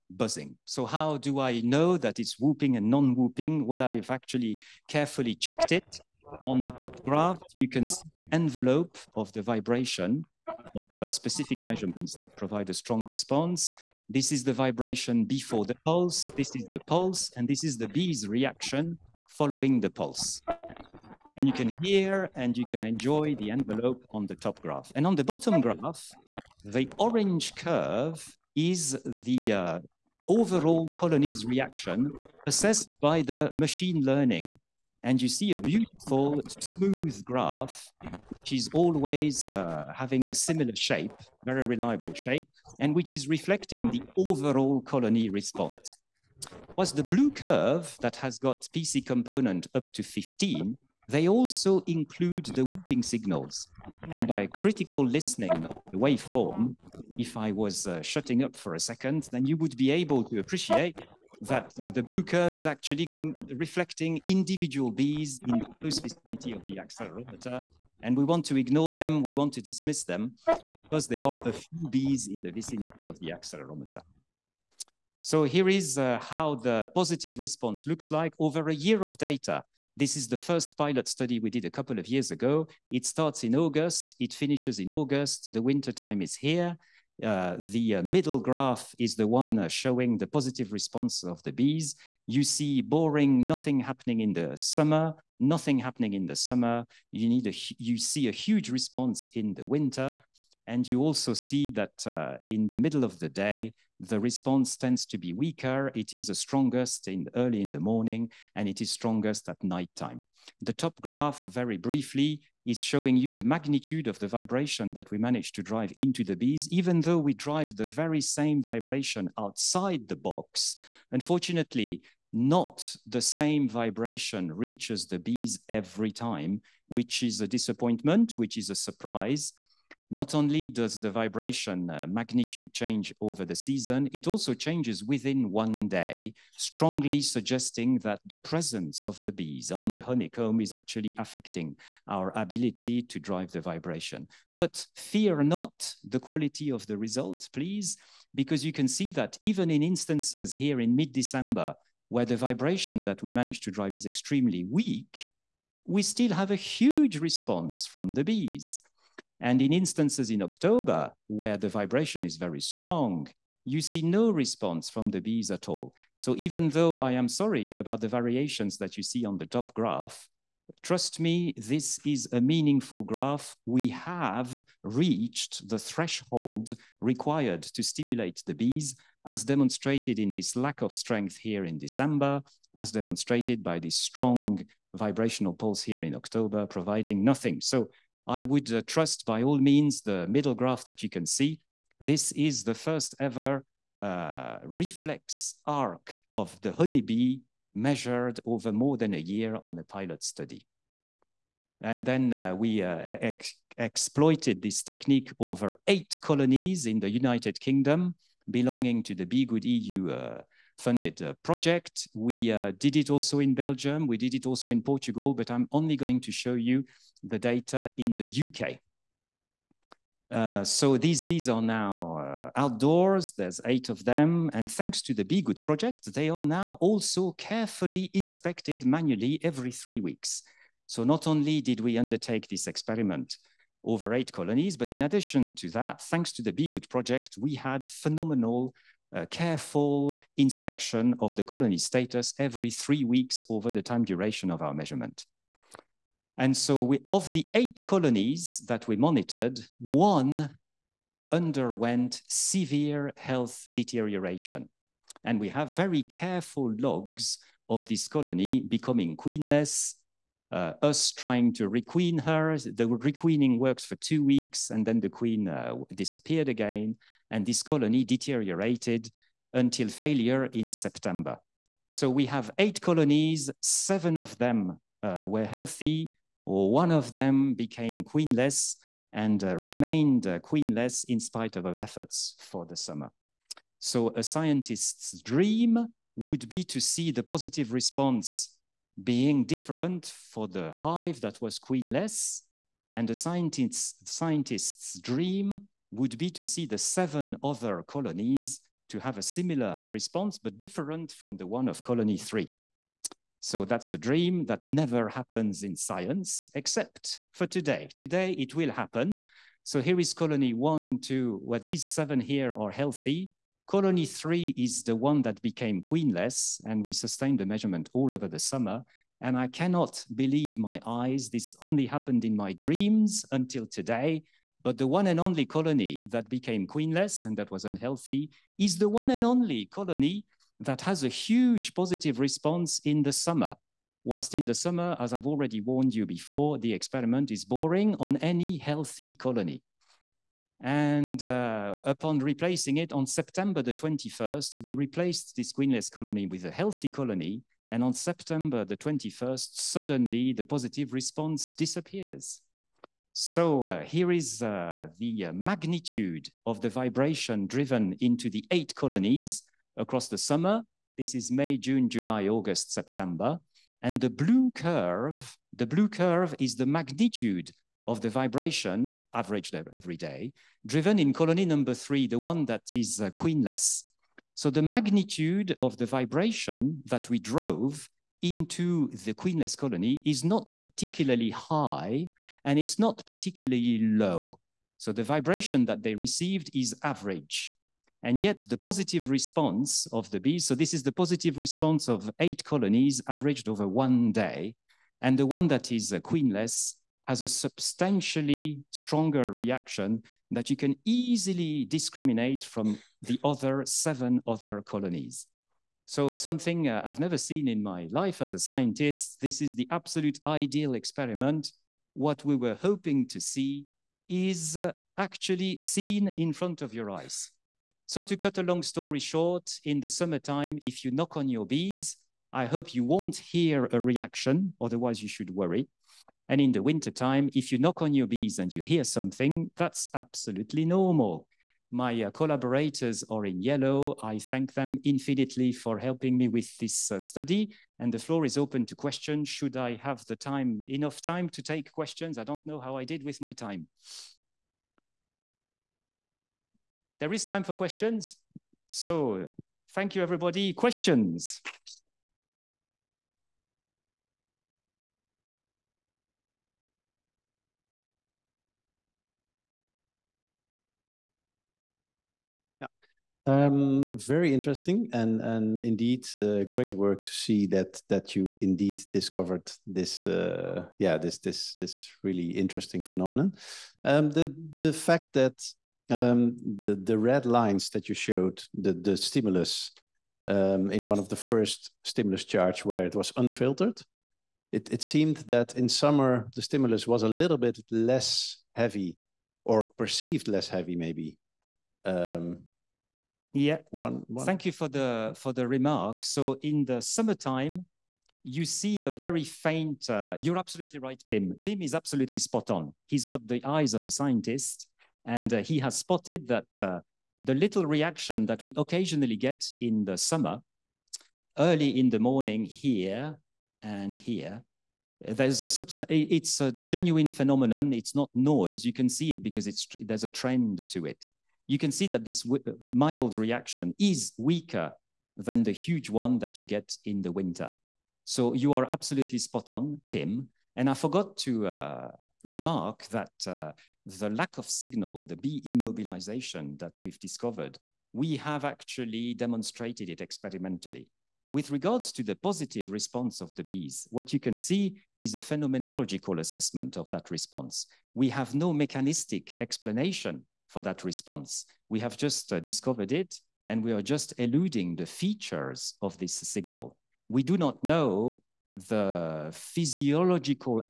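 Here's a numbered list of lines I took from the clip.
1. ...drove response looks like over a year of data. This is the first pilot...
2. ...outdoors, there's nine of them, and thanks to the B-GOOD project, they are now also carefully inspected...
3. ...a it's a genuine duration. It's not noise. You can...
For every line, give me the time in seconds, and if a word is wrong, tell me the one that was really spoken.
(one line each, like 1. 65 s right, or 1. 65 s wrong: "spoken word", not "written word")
1. 76 s wrong: "positive", not "drove"
2. 222 s wrong: "eight", not "nine"
3. 515 s wrong: "phenomenon", not "duration".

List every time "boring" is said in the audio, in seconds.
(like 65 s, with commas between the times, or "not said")
92 s, 337 s.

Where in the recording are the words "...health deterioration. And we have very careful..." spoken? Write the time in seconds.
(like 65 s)
253 s.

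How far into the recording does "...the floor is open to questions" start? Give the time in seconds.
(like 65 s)
437 s.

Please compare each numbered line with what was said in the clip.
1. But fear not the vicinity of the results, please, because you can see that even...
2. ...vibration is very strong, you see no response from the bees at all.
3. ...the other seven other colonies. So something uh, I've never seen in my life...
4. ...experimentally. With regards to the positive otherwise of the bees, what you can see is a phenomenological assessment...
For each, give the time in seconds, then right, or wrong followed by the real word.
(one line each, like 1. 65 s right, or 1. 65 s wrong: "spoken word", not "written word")
1. 144 s wrong: "quality", not "vicinity"
2. 161 s right
3. 403 s right
4. 539 s wrong: "response", not "otherwise".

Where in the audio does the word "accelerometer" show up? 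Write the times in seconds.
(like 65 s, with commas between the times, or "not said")
66 s, 73 s.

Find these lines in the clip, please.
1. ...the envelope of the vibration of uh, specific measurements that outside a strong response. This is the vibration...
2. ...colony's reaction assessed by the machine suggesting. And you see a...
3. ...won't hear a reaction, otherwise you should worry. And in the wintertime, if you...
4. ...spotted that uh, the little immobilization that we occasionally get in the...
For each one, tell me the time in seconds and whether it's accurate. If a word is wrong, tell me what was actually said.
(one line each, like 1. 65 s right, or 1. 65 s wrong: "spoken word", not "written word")
1. 8 s wrong: "provide", not "outside"
2. 30 s wrong: "learning", not "suggesting"
3. 422 s right
4. 505 s wrong: "reaction", not "immobilization".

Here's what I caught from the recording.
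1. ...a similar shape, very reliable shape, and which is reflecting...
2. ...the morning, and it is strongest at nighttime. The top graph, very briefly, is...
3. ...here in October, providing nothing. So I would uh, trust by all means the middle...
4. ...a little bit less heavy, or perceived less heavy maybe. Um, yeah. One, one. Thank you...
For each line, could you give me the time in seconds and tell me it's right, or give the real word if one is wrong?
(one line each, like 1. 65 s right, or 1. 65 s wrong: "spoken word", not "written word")
1. 40 s right
2. 107 s right
3. 185 s right
4. 487 s right.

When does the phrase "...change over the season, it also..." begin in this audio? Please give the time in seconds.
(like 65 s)
132 s.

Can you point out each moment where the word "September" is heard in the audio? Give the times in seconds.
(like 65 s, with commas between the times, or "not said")
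270 s, 343 s, 347 s, 362 s.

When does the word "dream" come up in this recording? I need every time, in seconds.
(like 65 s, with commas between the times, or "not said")
285 s, 294 s, 303 s, 322 s.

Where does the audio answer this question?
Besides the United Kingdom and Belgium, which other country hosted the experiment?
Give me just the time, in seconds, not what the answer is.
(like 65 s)
214 s.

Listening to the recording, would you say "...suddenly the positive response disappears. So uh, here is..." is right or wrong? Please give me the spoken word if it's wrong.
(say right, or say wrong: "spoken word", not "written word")
right.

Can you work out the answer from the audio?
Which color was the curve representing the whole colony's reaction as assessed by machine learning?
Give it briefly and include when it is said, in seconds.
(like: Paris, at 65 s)
Orange, at 26 s.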